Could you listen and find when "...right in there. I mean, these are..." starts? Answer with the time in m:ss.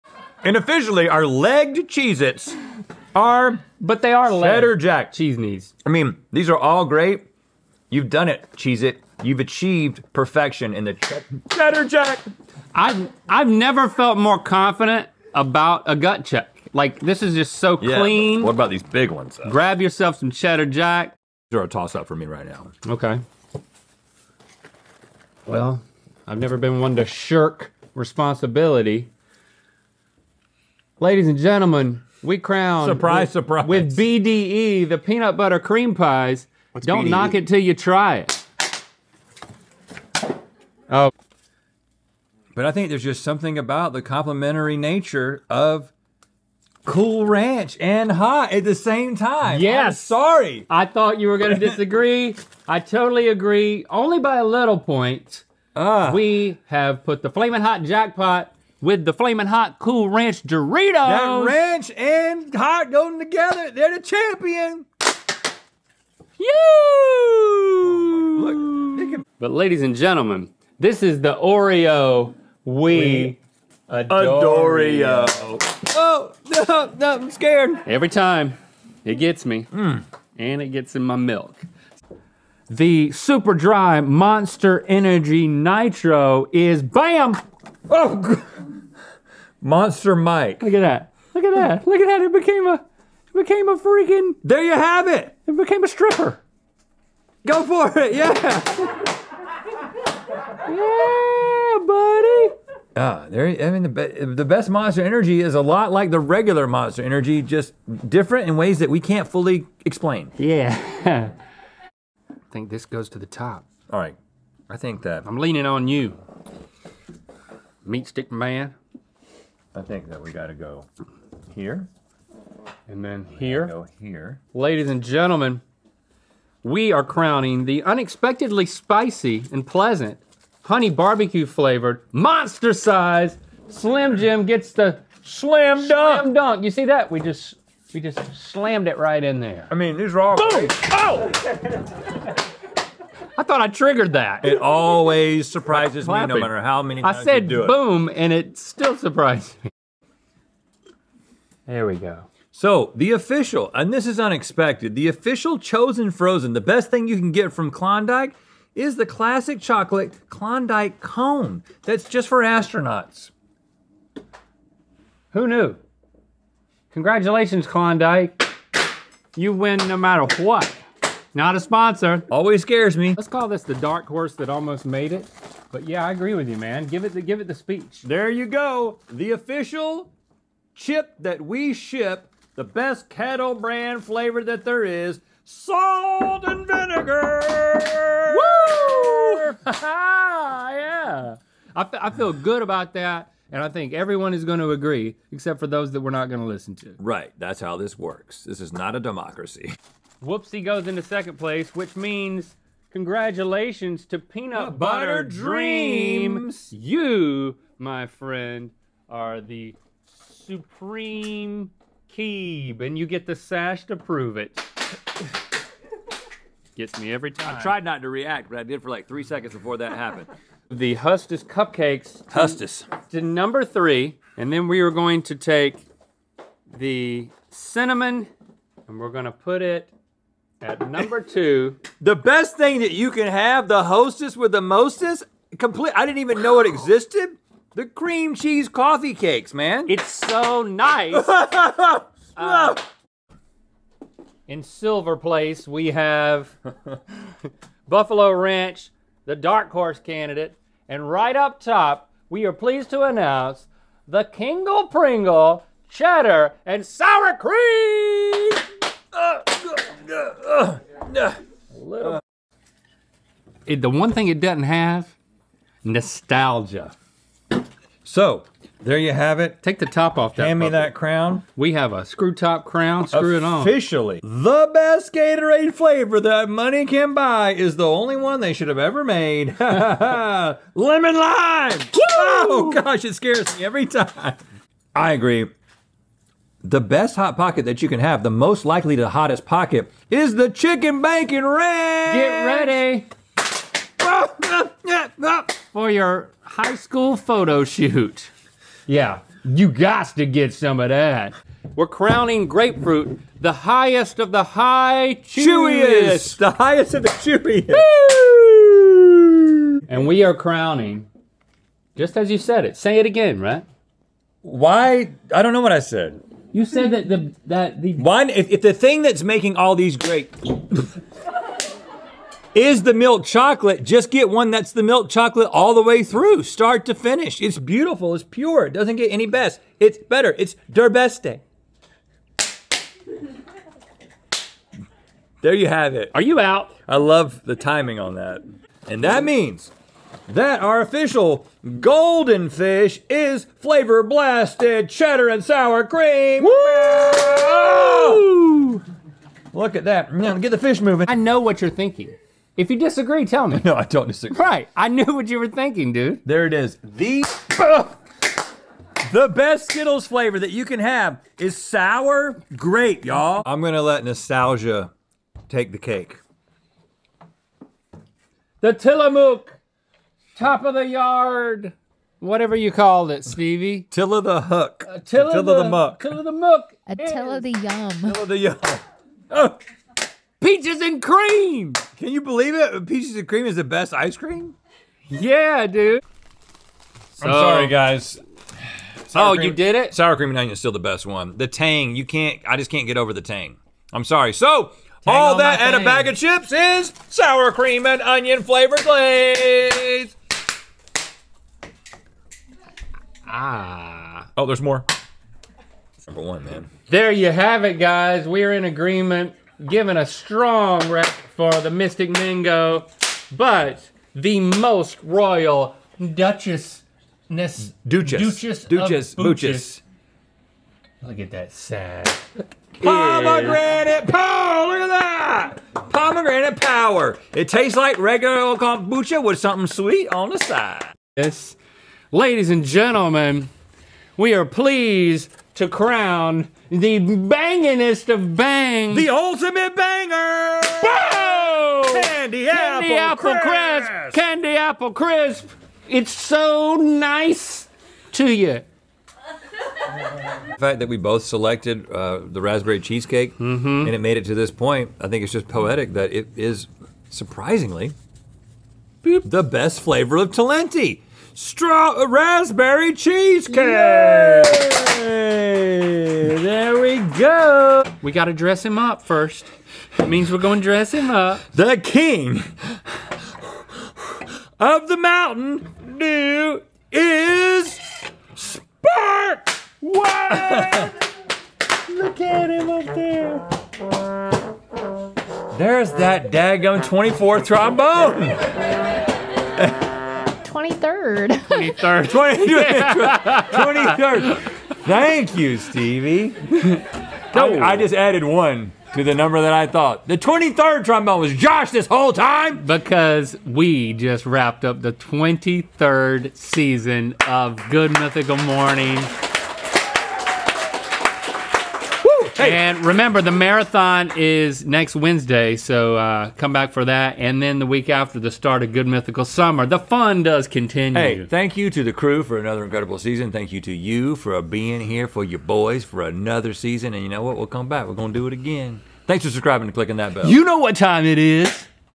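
2:18.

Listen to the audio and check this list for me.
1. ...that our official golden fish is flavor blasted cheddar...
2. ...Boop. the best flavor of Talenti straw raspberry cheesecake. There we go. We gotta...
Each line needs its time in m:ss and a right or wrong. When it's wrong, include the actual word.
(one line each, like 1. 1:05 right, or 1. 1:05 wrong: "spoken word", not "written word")
1. 5:40 right
2. 7:39 right.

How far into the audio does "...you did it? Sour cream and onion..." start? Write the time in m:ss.
6:29.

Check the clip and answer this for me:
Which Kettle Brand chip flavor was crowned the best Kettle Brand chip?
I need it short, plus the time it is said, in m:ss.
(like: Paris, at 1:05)
Salt and vinegar, at 3:05.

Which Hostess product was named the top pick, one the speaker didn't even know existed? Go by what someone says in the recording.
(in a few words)
Cream cheese coffee cakes.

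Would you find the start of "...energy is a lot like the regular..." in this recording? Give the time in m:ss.
1:45.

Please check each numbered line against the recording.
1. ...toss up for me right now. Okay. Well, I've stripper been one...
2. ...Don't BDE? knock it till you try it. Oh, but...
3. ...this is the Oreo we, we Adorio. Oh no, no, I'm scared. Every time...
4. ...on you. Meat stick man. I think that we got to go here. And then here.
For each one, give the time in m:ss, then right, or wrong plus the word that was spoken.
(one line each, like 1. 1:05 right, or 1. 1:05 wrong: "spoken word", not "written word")
1. 0:21 wrong: "never", not "stripper"
2. 0:36 right
3. 1:10 right
4. 1:55 right.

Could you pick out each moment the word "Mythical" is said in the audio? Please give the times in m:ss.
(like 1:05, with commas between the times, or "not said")
8:27, 8:38.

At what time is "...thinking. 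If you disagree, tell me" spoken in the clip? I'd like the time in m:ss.
5:51.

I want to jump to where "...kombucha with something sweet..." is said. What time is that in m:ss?
7:08.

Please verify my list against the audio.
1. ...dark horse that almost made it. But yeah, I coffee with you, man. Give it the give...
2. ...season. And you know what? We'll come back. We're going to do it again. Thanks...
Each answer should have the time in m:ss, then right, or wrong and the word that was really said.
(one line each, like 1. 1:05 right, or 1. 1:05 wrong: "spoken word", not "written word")
1. 2:53 wrong: "agree", not "coffee"
2. 8:46 right.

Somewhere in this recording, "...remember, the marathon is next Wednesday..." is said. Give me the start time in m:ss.
8:32.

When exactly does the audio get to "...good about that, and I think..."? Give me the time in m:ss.
3:12.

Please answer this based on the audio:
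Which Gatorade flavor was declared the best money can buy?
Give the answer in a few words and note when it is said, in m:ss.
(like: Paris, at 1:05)
Lemon lime, at 4:39.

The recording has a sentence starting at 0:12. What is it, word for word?
I've I've never felt more confident about a gut check.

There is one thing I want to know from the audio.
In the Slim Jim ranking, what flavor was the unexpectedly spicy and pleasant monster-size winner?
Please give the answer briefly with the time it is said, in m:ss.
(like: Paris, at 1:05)
Honey barbecue, at 2:10.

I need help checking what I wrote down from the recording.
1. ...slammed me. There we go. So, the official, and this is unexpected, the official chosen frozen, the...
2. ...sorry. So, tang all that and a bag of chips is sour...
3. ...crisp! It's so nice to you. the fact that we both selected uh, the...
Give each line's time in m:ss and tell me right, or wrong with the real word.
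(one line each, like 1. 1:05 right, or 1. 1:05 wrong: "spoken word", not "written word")
1. 2:28 wrong: "surprised", not "slammed"
2. 6:34 right
3. 7:24 right.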